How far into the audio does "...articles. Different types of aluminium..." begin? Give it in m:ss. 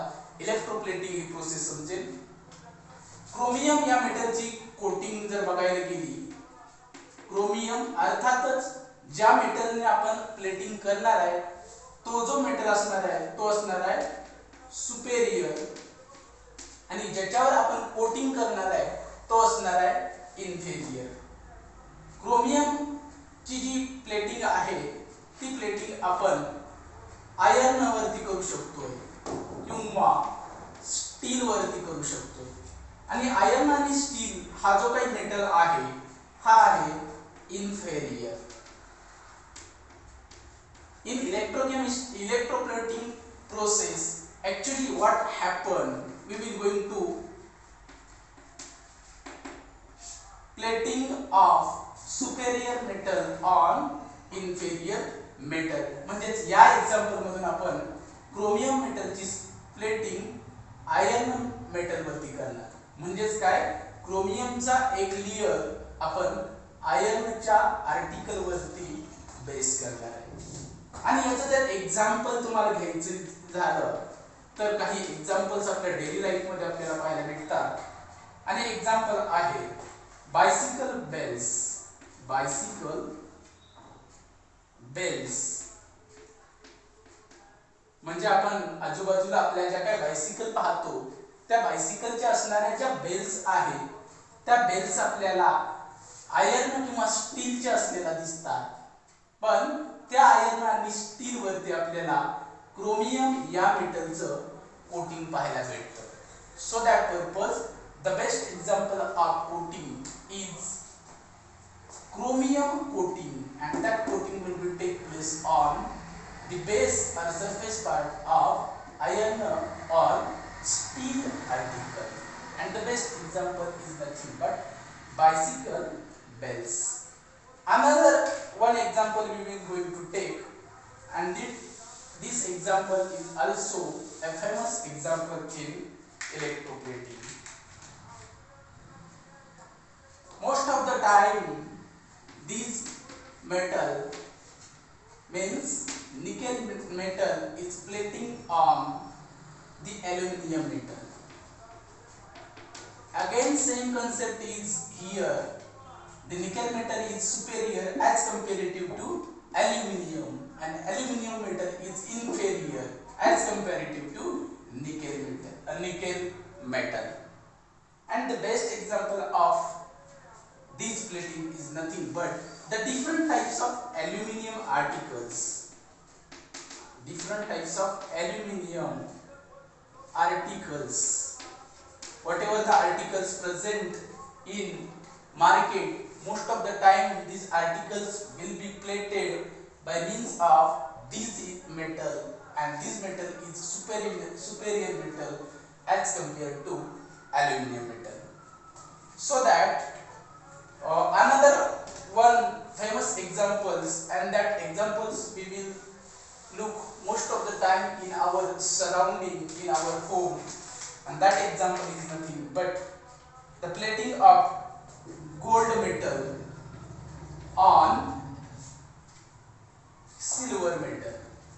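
2:54.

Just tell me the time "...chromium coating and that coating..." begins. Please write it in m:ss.
1:52.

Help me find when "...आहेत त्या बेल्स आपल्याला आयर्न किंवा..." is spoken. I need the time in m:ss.
1:33.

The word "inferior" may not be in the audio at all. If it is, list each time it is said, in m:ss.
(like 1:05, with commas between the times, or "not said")
2:42.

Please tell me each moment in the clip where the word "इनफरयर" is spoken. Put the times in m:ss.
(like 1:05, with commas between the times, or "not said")
0:20, 0:37, 0:54.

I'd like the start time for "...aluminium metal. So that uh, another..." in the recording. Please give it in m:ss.
3:17.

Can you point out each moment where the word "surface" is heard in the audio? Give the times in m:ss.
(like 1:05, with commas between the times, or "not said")
1:57.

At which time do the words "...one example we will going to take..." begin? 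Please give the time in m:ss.
2:08.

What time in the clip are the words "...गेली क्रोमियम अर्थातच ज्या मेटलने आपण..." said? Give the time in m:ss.
0:05.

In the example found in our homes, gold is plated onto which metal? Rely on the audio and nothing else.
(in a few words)
Silver.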